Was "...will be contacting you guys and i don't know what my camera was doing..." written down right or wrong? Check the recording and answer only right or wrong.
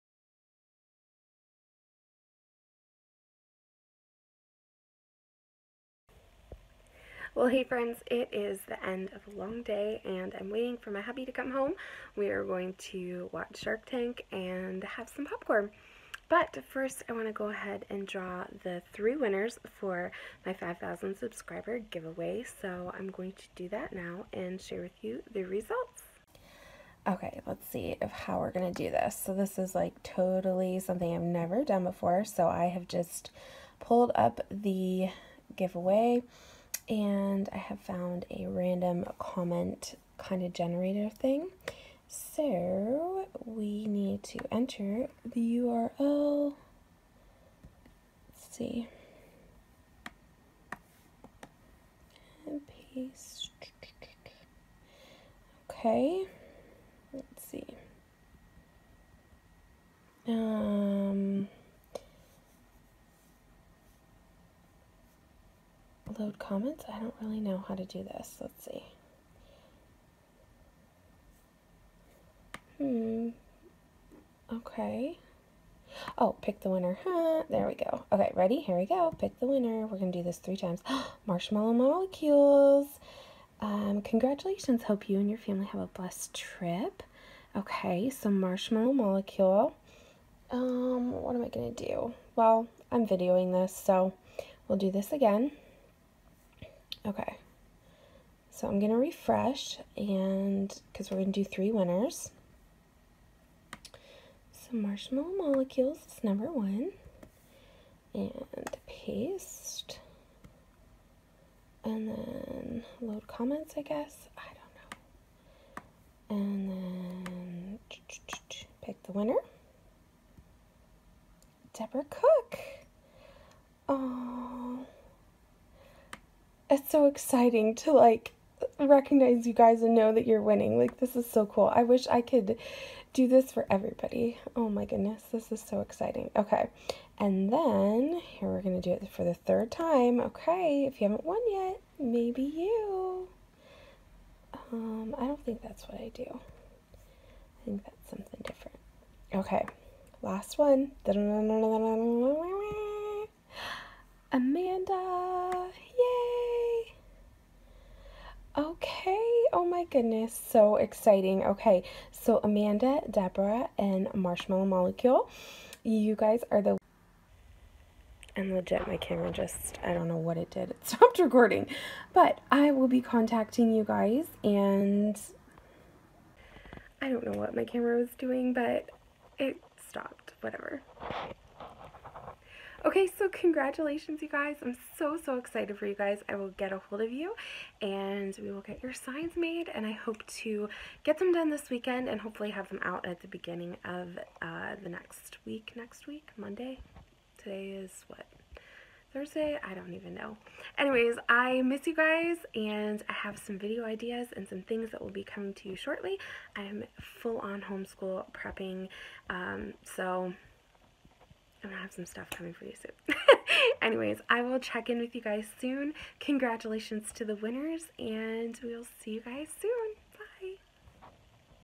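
right.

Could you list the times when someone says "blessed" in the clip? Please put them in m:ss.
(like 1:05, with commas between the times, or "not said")
1:25.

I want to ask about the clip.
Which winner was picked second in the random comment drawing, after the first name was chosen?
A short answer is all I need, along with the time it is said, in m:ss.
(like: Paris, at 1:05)
Deborah Cook, at 2:01.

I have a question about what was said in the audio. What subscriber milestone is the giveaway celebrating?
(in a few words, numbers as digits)
5,000.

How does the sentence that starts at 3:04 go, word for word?
I'm so, so excited for you guys.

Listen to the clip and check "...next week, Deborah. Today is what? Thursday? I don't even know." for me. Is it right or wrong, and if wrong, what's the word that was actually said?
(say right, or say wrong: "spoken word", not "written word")
wrong: "Monday", not "Deborah".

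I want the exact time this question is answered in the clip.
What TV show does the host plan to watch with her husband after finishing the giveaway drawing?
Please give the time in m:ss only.
0:13.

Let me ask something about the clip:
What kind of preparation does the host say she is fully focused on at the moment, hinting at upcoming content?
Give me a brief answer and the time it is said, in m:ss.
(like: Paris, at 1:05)
homeschool prepping, at 3:27.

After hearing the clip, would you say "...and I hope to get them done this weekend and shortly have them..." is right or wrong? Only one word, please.
wrong.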